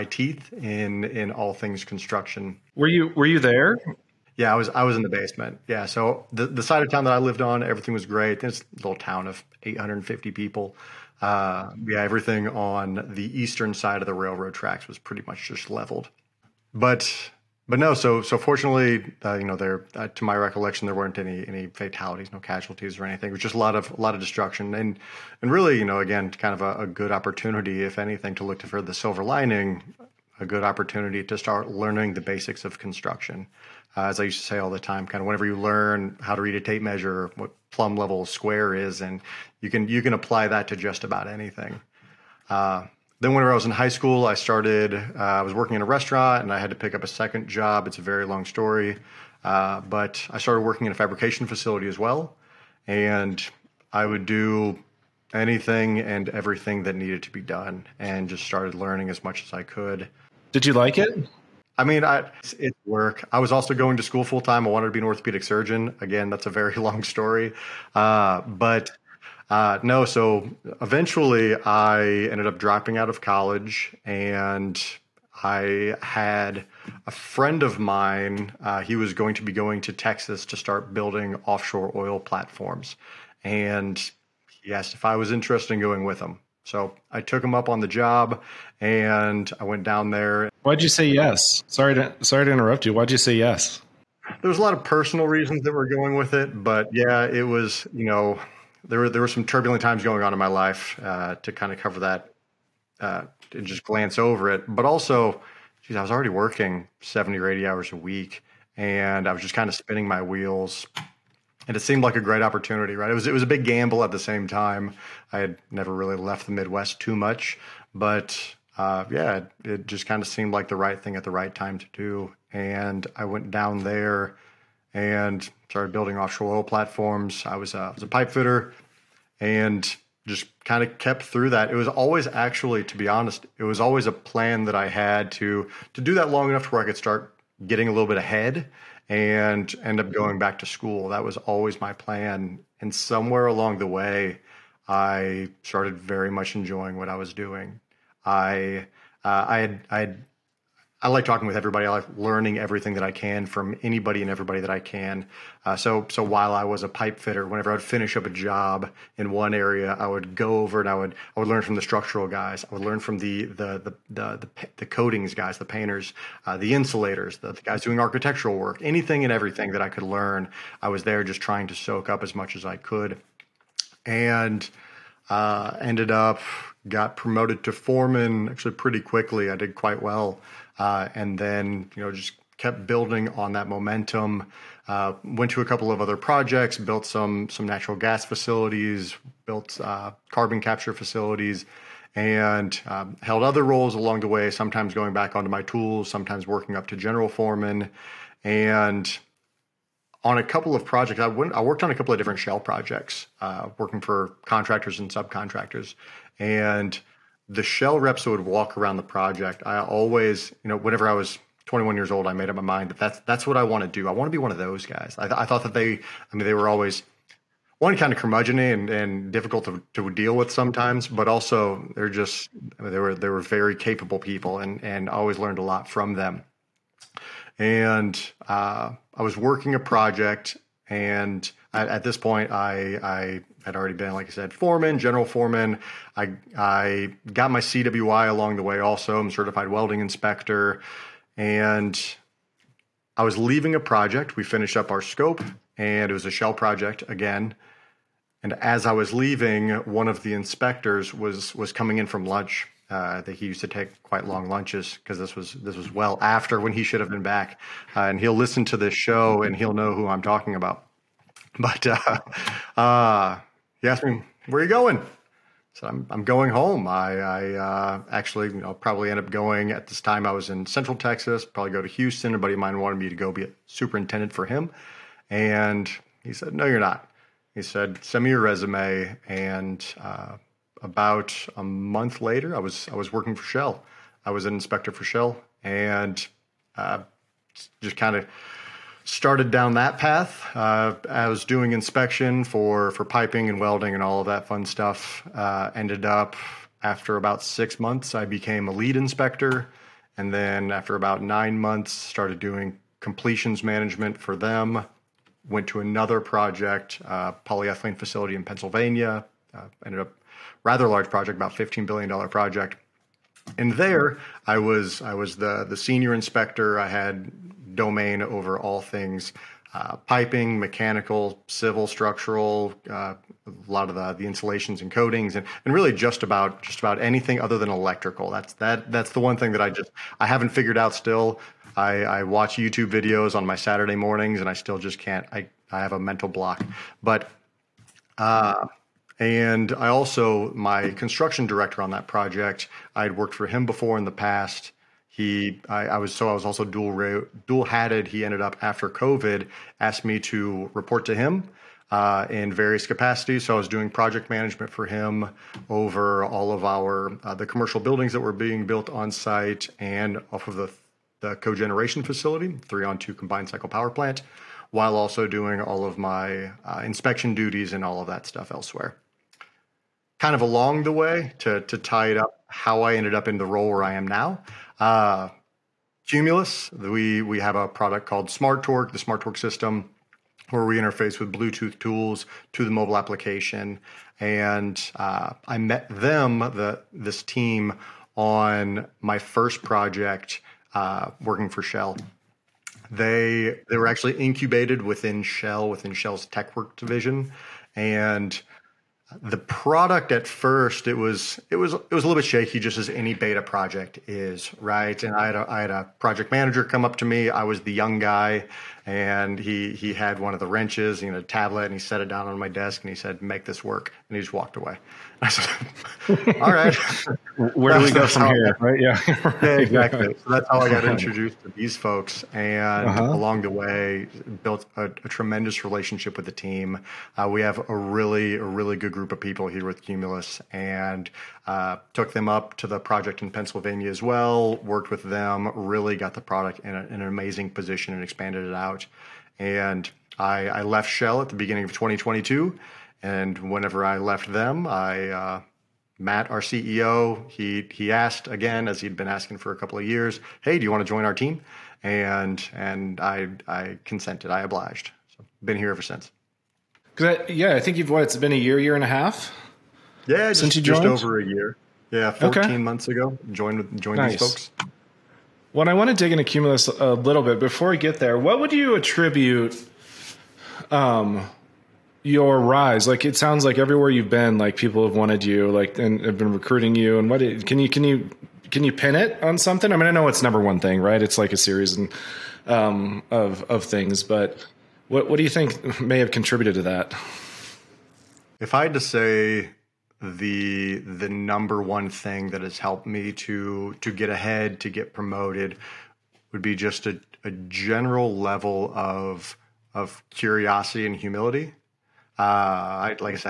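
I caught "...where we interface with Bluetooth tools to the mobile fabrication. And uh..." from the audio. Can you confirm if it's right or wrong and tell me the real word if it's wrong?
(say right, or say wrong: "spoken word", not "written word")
wrong: "application", not "fabrication".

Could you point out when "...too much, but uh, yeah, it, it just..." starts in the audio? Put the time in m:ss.
1:56.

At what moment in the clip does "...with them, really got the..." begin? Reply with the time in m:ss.
7:14.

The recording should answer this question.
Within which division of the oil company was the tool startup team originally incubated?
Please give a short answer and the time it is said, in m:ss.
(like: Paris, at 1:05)
TechWorks, at 6:36.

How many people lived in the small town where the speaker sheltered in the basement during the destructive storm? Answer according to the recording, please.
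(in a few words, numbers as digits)
850.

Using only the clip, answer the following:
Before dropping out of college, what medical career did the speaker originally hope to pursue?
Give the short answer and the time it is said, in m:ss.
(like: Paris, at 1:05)
orthopedic surgeon, at 1:05.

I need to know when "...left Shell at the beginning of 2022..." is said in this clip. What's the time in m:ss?
7:20.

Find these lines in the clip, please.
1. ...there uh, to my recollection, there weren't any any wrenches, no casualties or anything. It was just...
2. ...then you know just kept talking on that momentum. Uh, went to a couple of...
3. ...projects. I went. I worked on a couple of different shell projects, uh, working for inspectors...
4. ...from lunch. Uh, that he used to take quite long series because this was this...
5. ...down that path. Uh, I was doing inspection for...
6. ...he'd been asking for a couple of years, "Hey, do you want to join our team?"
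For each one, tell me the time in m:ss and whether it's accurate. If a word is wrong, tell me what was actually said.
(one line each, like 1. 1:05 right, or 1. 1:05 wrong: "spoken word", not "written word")
1. 0:19 wrong: "fatalities", not "wrenches"
2. 3:01 wrong: "building", not "talking"
3. 3:20 wrong: "contractors", not "inspectors"
4. 4:12 wrong: "lunches", not "series"
5. 4:49 right
6. 7:28 right.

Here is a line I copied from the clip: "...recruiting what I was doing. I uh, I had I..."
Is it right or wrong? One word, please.
wrong.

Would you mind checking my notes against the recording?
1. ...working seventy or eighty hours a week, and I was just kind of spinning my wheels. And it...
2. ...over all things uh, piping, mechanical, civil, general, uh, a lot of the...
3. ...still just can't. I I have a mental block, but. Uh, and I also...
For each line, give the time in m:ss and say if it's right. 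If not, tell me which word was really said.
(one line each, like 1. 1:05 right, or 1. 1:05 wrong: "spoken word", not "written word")
1. 1:46 right
2. 5:18 wrong: "structural", not "general"
3. 5:34 right.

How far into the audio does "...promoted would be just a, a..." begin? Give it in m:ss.
8:14.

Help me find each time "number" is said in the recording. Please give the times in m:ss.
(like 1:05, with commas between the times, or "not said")
8:00, 8:11.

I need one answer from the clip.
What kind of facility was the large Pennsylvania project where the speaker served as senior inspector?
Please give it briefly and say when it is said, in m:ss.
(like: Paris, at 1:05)
polyethylene facility, at 5:07.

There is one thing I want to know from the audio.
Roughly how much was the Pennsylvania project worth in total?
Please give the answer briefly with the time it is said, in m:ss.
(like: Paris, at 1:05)
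15 billion dollars, at 5:11.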